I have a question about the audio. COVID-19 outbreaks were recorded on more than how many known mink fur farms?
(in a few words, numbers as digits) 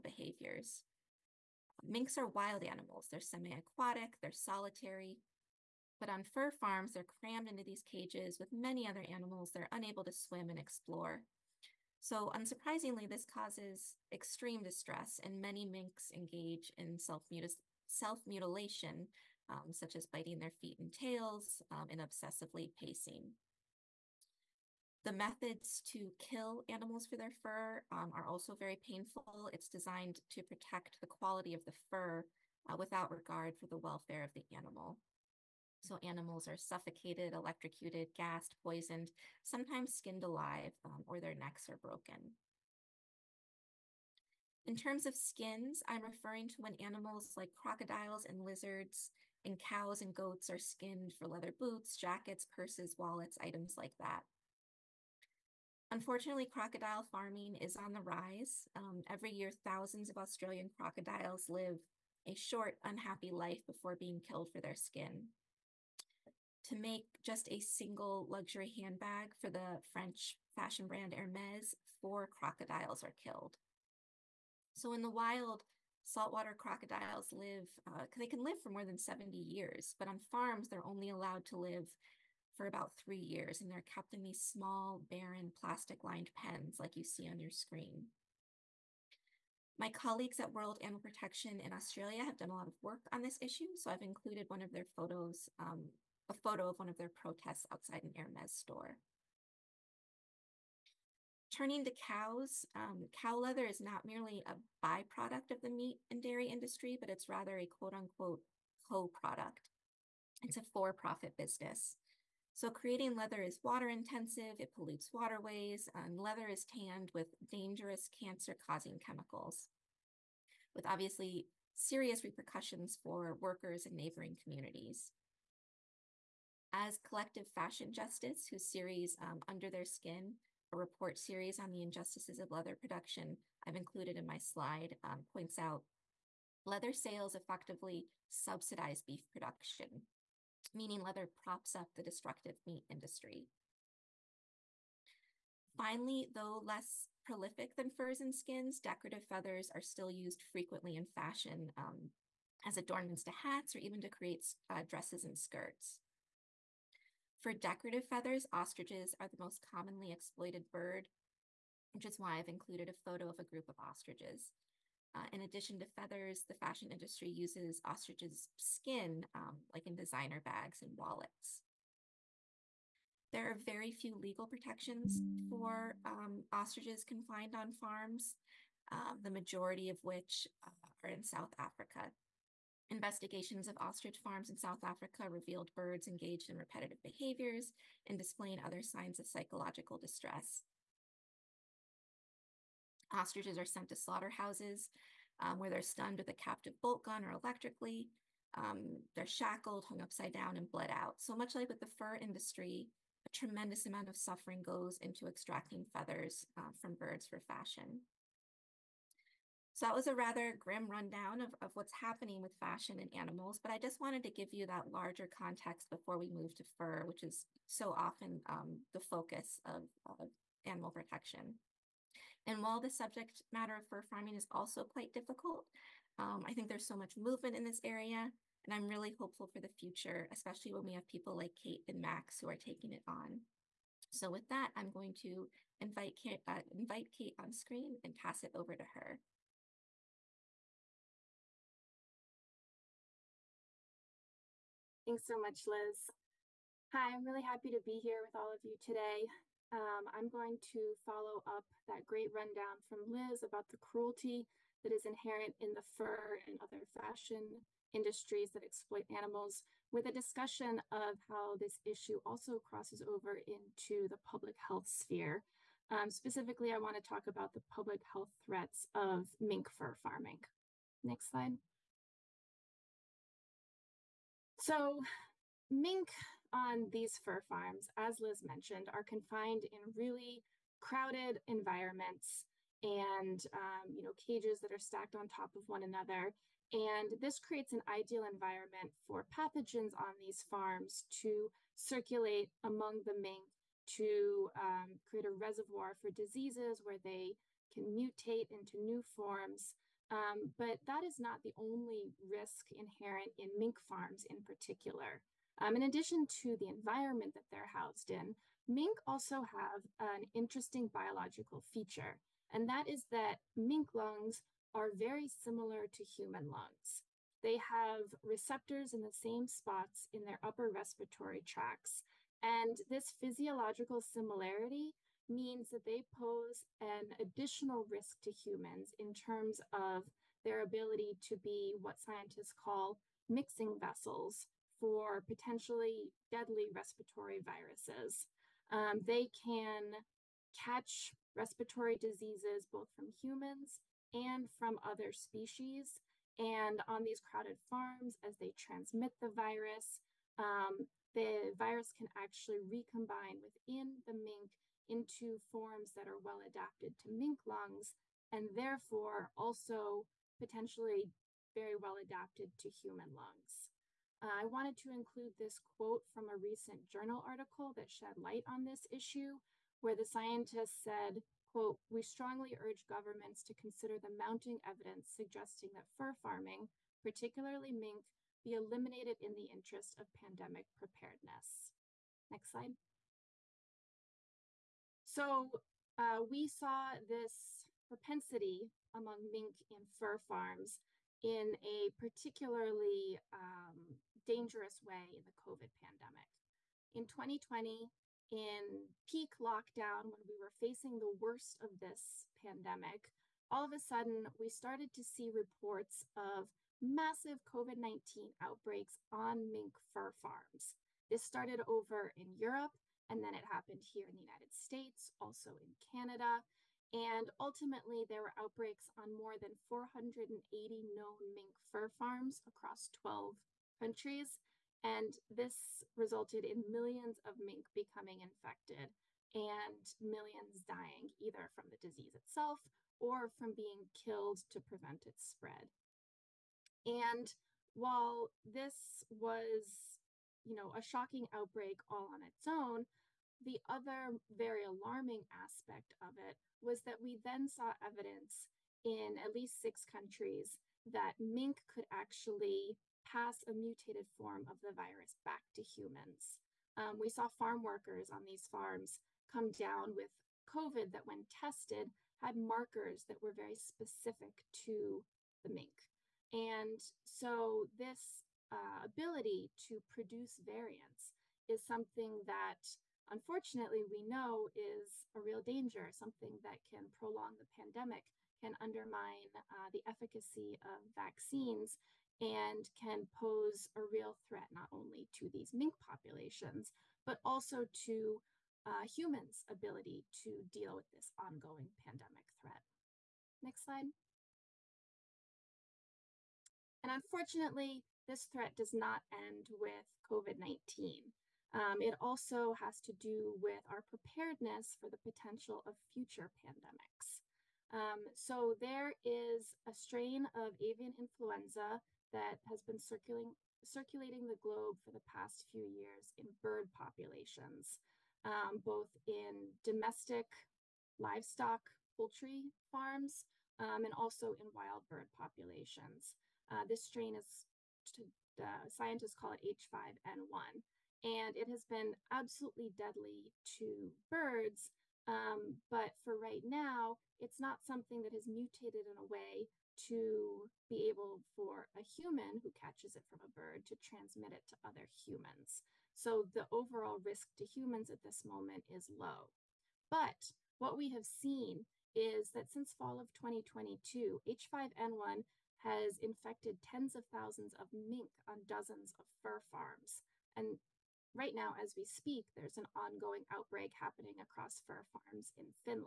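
480.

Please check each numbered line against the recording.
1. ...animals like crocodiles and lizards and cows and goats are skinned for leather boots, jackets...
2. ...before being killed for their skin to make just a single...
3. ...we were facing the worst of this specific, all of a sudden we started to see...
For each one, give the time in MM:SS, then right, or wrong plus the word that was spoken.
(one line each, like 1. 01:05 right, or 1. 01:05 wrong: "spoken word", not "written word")
1. 00:46 right
2. 01:03 right
3. 06:40 wrong: "pandemic", not "specific".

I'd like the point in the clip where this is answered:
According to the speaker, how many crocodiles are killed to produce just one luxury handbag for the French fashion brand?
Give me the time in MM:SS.
01:12.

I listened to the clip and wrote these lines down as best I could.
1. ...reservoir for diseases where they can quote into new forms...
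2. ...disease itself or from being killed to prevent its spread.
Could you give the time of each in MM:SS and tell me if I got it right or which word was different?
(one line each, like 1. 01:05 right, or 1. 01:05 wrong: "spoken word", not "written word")
1. 04:55 wrong: "mutate", not "quote"
2. 07:11 right.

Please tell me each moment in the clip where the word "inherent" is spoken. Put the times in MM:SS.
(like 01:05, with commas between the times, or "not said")
04:15, 05:02.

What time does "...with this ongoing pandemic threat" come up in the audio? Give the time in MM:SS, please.
08:10.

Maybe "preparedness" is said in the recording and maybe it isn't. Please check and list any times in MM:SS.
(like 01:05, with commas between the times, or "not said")
06:20, 08:23.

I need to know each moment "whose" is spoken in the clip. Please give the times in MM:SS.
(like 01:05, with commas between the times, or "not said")
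02:08.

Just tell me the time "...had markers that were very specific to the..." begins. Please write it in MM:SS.
07:42.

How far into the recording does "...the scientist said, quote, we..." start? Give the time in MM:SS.
06:09.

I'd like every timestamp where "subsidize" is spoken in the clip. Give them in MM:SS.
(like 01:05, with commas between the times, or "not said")
02:18.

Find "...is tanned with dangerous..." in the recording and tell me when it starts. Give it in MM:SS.
01:56.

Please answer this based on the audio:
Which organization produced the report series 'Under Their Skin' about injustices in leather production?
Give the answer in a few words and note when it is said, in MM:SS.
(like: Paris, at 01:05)
Collective Fashion Justice, at 02:06.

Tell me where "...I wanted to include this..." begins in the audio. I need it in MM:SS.
06:04.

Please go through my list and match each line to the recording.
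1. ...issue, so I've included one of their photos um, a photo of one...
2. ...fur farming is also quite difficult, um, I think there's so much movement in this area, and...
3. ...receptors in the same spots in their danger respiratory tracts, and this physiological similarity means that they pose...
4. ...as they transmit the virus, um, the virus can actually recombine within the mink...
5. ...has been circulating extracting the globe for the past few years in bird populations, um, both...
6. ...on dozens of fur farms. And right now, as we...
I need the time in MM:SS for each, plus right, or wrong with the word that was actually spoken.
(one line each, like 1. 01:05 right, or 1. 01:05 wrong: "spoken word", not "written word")
1. 01:33 right
2. 03:43 right
3. 05:18 wrong: "upper", not "danger"
4. 05:48 right
5. 08:32 wrong: "circulating", not "extracting"
6. 09:18 right.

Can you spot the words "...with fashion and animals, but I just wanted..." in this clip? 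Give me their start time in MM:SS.
03:32.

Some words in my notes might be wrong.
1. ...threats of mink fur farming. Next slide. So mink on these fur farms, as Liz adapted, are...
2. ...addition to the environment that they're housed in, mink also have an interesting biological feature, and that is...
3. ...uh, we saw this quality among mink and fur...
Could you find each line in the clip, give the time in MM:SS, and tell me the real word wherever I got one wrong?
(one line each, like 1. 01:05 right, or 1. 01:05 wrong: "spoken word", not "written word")
1. 04:28 wrong: "mentioned", not "adapted"
2. 05:05 right
3. 06:25 wrong: "propensity", not "quality".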